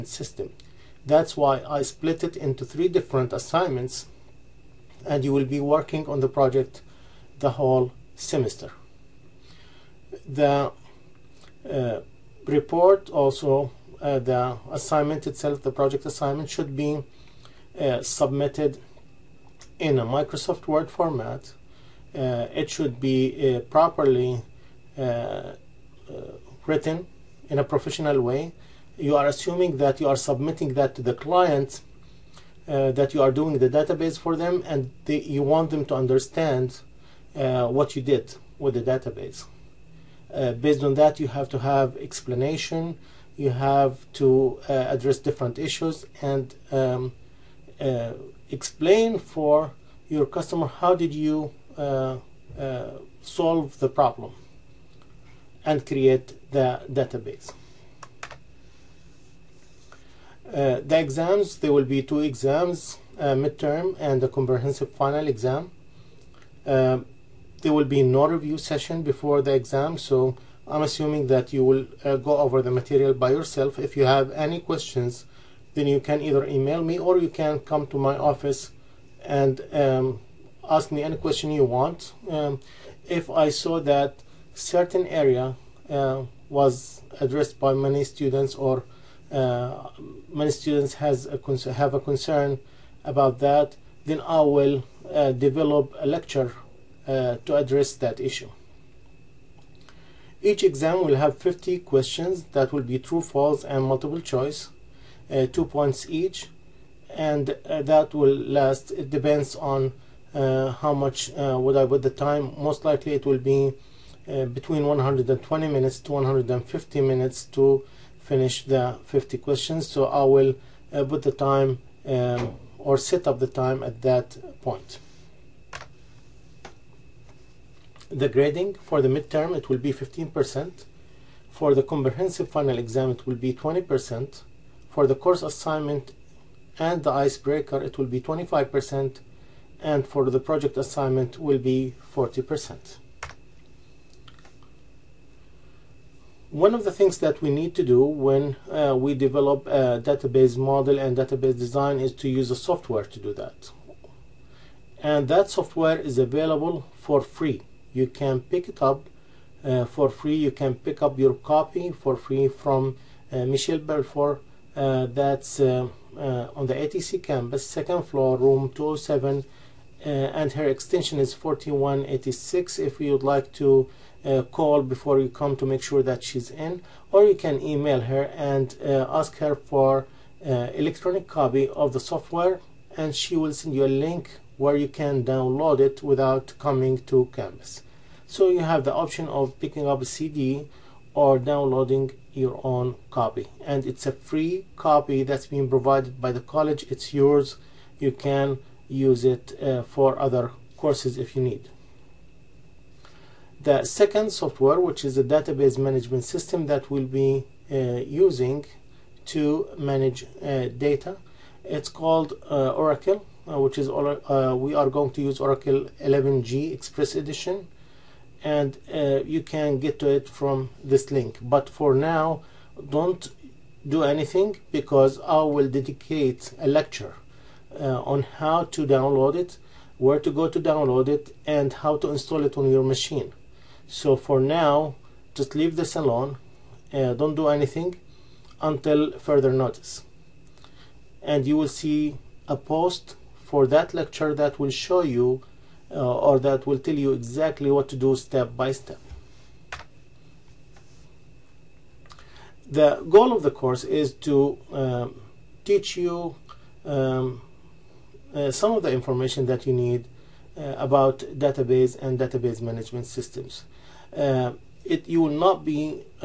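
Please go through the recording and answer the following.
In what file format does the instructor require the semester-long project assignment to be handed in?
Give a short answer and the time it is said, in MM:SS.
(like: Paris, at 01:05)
Microsoft Word, at 00:20.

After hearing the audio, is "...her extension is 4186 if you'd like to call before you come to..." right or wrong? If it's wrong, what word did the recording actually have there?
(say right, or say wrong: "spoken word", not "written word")
right.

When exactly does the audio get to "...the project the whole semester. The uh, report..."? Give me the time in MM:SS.
00:06.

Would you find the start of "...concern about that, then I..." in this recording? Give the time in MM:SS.
01:32.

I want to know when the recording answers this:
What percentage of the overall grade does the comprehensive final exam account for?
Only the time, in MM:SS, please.
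02:13.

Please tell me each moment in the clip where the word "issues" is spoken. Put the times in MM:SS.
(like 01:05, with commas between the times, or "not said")
00:45, 01:38.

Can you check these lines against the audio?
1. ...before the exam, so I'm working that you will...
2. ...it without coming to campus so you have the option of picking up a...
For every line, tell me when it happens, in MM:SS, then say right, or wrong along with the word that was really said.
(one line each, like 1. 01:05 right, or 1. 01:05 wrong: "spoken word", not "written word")
1. 01:09 wrong: "assuming", not "working"
2. 03:05 right.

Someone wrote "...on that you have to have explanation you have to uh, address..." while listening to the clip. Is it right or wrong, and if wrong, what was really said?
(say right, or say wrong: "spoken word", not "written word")
right.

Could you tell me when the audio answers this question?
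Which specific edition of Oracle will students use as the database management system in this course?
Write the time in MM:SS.
03:35.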